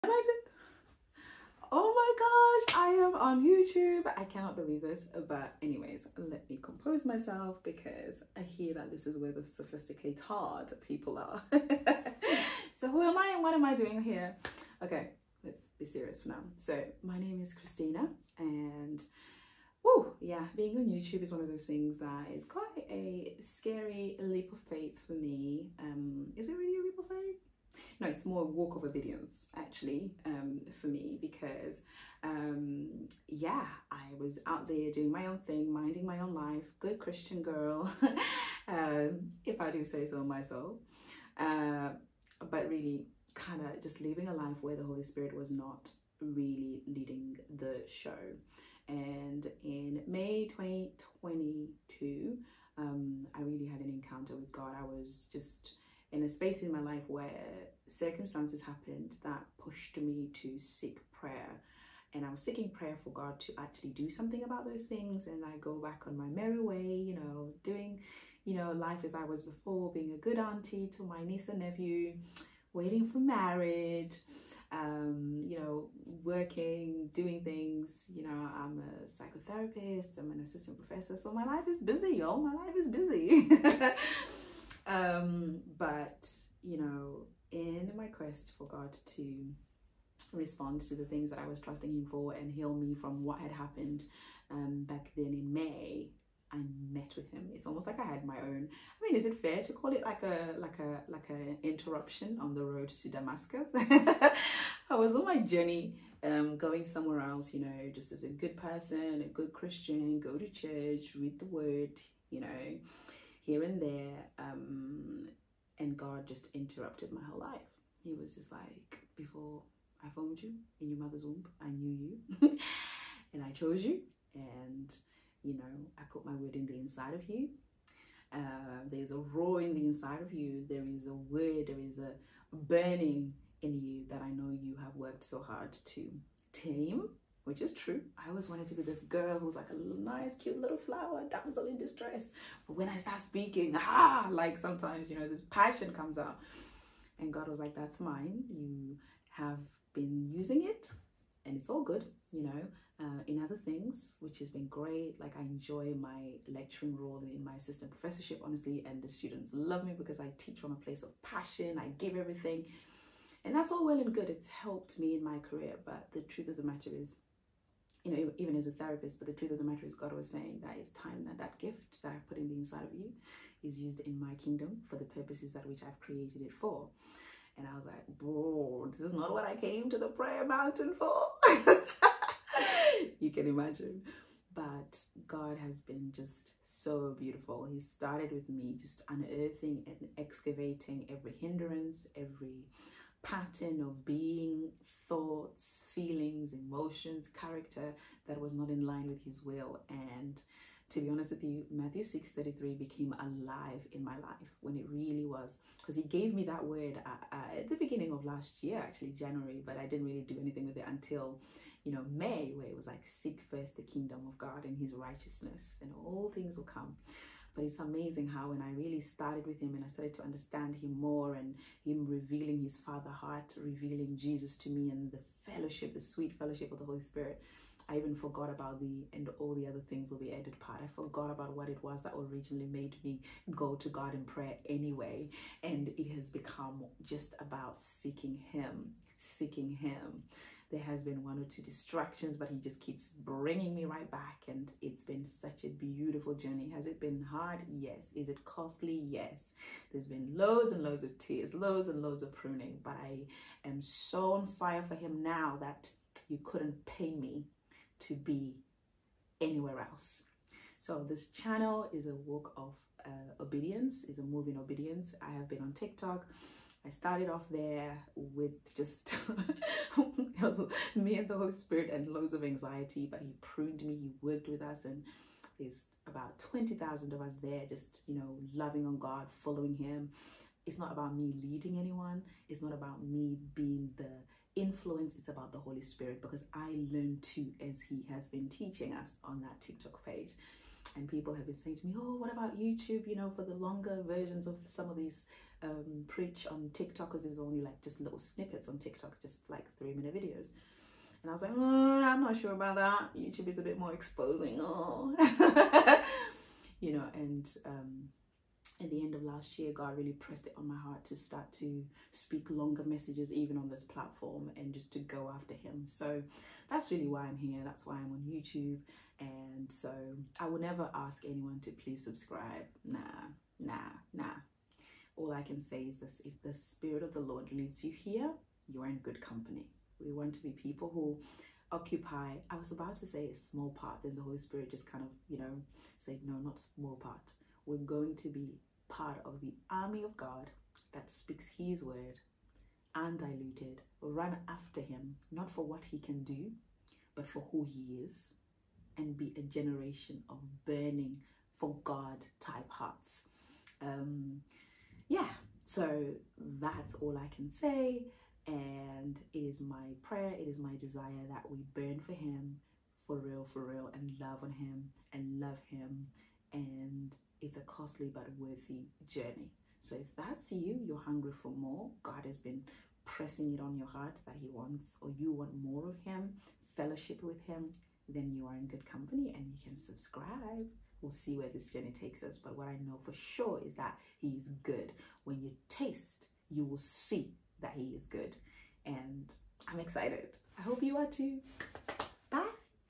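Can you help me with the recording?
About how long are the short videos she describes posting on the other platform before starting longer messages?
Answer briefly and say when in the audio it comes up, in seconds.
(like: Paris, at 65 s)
3 minutes, at 299 s.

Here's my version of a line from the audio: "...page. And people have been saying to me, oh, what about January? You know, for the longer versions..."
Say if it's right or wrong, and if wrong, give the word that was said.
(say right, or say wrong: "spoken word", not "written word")
wrong: "YouTube", not "January".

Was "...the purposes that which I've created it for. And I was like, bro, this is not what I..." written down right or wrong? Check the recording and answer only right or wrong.
right.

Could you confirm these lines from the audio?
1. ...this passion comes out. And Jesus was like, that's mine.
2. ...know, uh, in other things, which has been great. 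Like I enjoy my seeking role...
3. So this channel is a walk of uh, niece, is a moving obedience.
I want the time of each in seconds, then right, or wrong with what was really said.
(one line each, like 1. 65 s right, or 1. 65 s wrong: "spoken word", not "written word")
1. 145 s wrong: "God", not "Jesus"
2. 152 s wrong: "lecturing", not "seeking"
3. 260 s wrong: "obedience", not "niece".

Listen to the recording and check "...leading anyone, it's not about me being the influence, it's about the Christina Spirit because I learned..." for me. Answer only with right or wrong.
wrong.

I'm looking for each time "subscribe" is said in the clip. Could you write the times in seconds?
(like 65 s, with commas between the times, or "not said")
322 s, 379 s.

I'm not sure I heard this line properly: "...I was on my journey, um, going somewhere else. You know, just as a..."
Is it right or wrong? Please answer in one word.
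right.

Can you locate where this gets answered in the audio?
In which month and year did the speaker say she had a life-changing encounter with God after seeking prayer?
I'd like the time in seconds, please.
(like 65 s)
50 s.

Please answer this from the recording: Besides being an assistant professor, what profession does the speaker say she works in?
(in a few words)
Psychotherapist.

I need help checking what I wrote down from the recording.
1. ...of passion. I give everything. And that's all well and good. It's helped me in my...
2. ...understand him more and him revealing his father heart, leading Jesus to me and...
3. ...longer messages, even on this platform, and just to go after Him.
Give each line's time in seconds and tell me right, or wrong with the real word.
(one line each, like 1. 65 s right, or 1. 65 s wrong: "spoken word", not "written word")
1. 161 s right
2. 220 s wrong: "revealing", not "leading"
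3. 312 s right.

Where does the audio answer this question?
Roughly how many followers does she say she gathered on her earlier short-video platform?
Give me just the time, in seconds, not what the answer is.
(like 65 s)
276 s.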